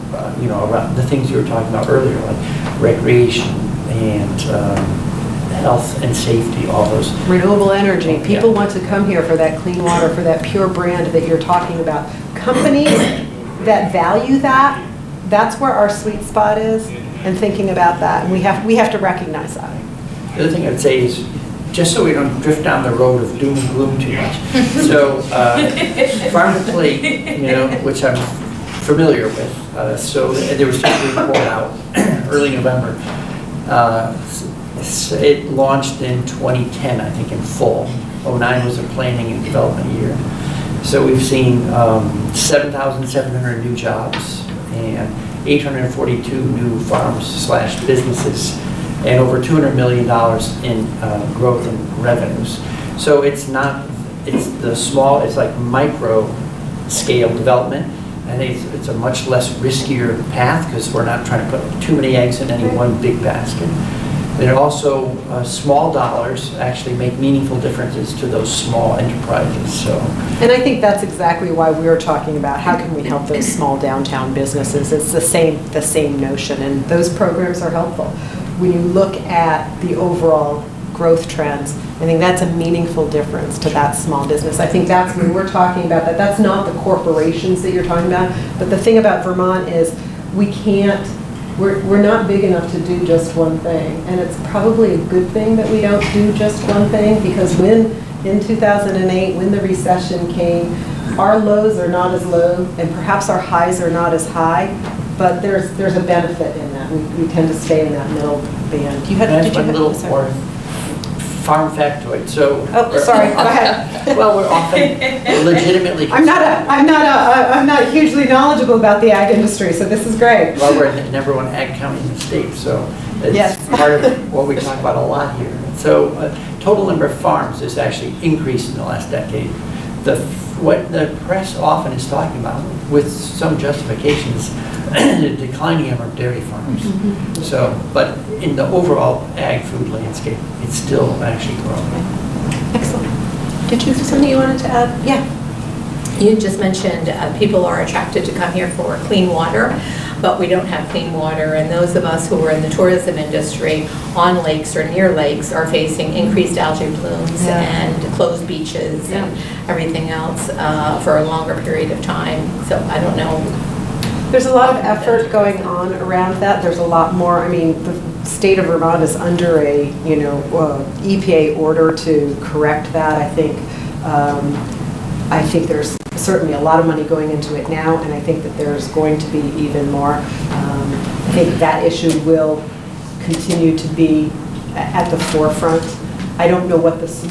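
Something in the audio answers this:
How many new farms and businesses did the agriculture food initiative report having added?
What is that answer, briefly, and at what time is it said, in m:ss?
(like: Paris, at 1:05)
842, at 0:45.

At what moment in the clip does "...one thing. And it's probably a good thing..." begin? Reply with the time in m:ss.
1:33.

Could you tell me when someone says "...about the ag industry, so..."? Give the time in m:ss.
1:58.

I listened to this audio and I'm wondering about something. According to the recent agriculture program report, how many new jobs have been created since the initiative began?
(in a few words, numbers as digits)
7,700.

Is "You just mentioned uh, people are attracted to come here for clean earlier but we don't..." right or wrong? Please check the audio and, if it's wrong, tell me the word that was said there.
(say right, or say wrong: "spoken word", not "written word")
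wrong: "water", not "earlier".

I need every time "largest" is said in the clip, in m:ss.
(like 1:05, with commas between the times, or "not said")
not said.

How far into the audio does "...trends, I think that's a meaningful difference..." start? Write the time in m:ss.
1:21.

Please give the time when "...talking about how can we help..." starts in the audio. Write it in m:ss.
1:11.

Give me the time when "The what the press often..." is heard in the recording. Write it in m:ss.
2:10.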